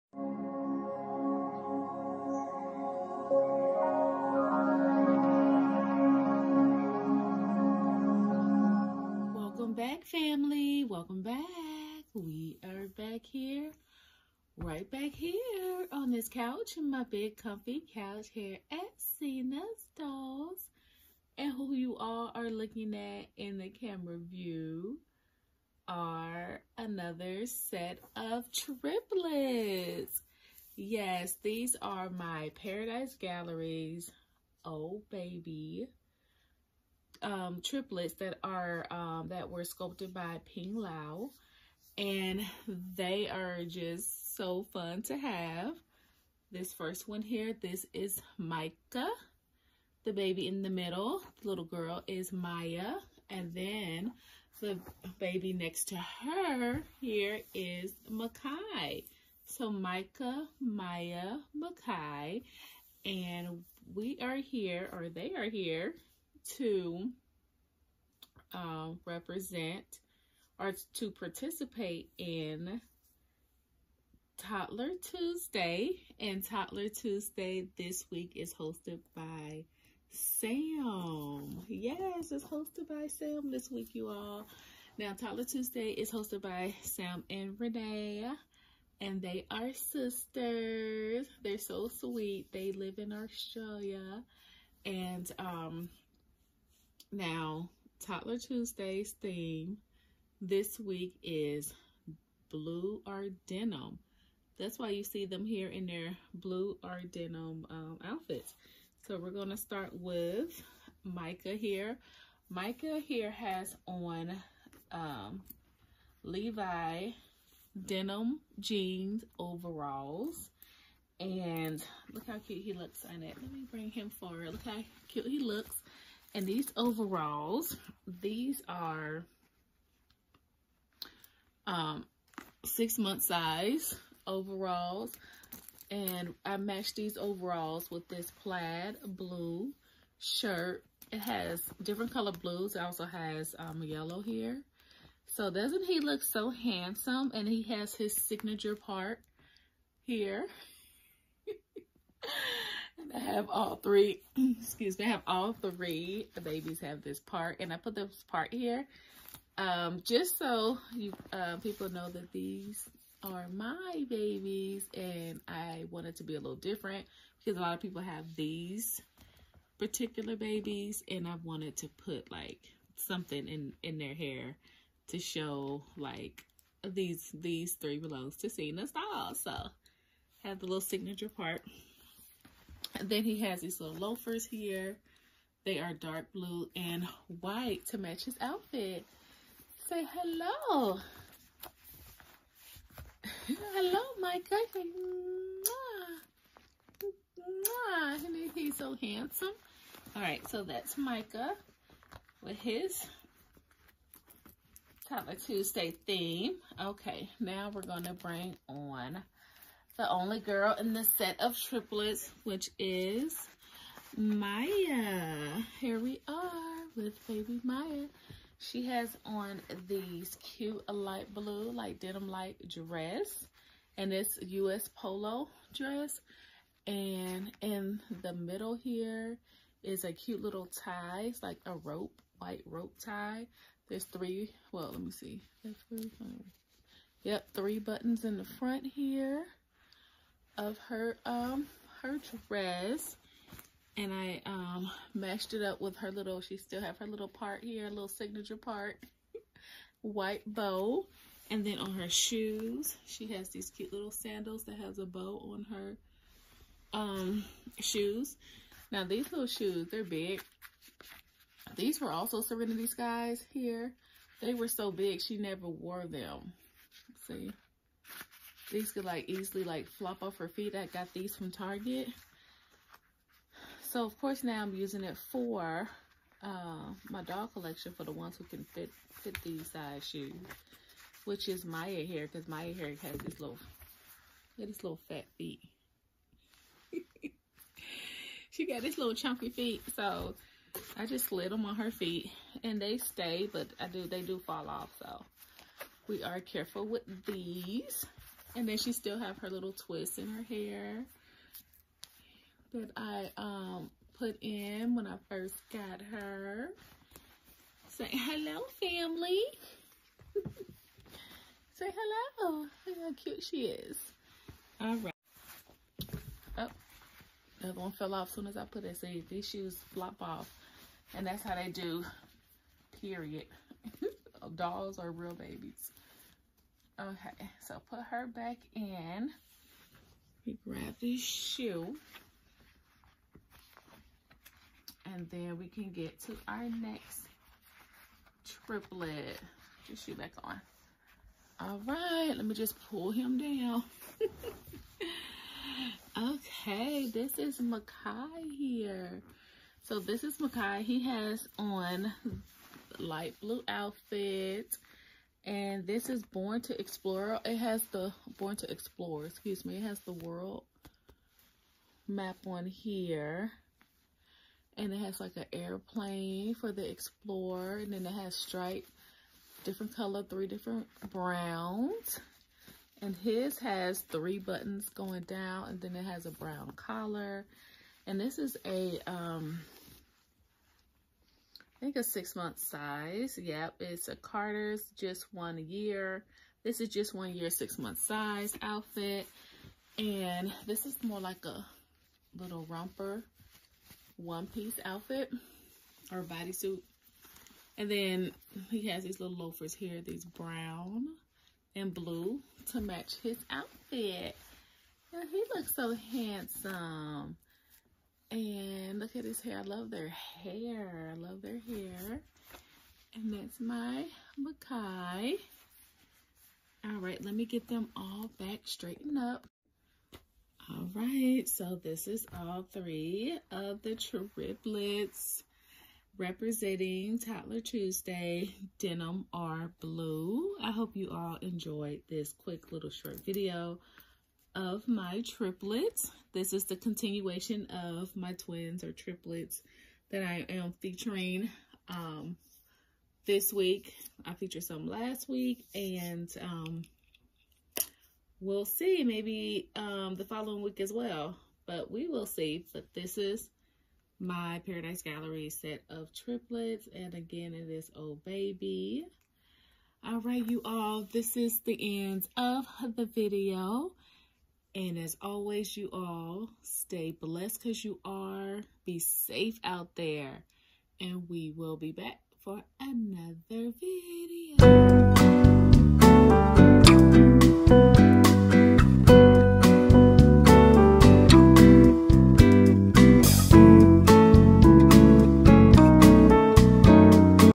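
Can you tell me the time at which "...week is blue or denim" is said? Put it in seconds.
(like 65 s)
100 s.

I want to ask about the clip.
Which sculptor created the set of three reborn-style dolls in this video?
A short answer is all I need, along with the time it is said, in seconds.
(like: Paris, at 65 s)
Ping Lau, at 40 s.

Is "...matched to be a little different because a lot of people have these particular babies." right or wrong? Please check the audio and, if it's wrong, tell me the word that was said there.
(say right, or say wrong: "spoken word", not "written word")
wrong: "wanted", not "matched".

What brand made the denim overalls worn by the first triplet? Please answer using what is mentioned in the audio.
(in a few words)
Levi.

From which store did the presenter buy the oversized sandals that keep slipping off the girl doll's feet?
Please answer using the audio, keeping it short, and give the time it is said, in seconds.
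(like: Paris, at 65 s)
Target, at 271 s.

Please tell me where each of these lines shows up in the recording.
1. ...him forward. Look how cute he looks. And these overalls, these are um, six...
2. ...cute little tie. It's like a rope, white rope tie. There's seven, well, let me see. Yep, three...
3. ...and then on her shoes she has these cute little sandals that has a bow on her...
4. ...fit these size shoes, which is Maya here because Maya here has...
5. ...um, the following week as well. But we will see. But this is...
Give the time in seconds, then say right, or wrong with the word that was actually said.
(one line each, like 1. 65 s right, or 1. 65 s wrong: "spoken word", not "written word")
1. 123 s right
2. 230 s wrong: "three", not "seven"
3. 251 s right
4. 279 s right
5. 449 s right.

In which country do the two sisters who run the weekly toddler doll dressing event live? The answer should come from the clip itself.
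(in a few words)
Australia.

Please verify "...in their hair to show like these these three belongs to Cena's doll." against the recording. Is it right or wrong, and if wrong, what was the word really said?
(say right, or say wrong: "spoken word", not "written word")
right.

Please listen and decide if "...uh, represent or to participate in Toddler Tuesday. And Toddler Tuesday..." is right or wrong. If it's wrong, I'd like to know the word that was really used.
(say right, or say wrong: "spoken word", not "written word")
right.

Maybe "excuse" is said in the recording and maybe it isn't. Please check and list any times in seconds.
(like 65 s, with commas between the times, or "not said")
154 s, 359 s.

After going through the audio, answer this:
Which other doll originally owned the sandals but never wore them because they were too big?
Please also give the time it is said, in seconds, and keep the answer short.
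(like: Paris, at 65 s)
Serenity Skies, at 262 s.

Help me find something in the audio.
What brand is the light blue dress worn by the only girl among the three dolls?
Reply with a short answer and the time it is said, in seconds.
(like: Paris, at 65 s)
U.S. Polo, at 224 s.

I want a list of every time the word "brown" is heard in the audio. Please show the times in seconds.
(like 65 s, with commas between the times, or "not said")
371 s, 376 s, 400 s.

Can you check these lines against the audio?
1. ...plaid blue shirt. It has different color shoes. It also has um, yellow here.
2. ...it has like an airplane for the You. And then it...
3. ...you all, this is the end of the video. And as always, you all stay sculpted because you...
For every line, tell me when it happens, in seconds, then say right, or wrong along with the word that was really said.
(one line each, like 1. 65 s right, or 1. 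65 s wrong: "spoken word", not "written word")
1. 138 s wrong: "blues", not "shoes"
2. 364 s wrong: "Explorer", not "You"
3. 460 s wrong: "blessed", not "sculpted".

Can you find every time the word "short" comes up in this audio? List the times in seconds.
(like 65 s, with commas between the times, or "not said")
432 s.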